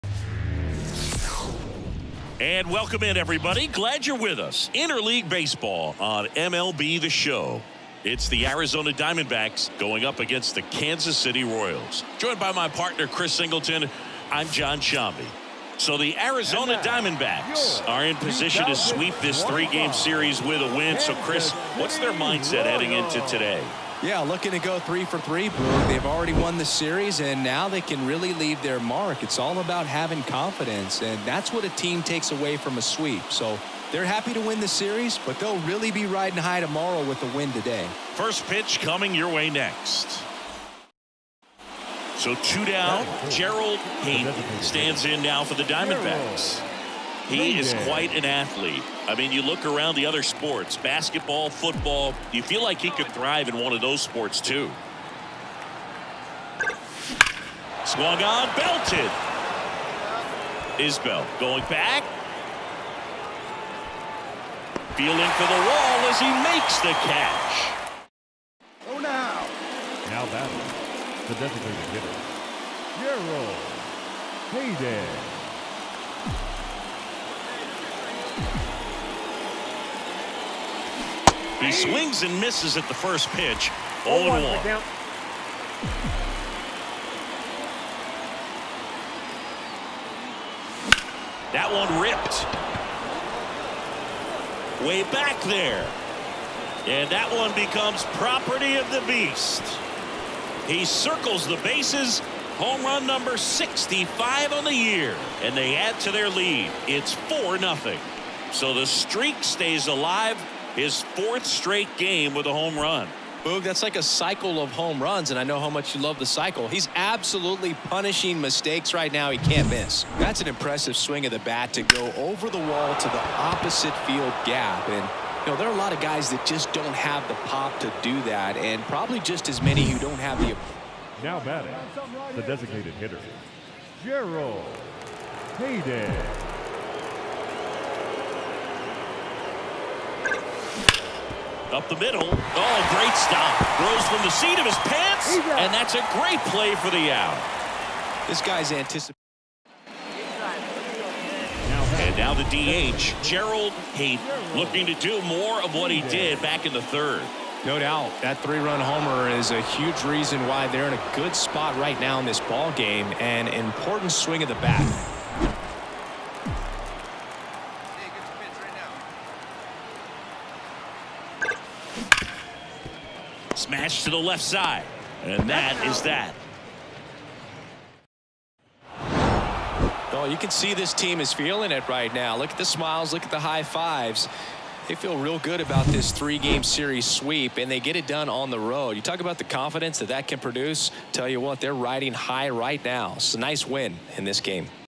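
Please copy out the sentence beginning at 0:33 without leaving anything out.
So they're happy to win the series, but they'll really be riding high tomorrow with the win today.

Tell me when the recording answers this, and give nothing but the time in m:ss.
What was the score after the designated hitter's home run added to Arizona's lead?
1:47.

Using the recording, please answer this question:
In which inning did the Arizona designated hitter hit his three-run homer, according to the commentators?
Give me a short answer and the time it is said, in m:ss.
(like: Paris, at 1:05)
third, at 2:36.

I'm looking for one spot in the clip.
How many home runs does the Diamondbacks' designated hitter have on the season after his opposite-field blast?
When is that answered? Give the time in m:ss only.
1:43.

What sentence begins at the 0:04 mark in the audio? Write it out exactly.
Interleague Baseball on MLB The Show.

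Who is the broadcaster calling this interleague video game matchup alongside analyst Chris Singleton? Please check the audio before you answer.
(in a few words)
Jon Sciambi.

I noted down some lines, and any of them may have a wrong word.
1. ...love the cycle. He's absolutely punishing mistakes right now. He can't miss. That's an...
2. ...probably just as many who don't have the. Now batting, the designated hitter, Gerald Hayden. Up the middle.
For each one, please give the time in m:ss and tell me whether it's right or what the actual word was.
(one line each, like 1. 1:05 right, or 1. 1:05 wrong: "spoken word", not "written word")
1. 1:56 right
2. 2:08 right.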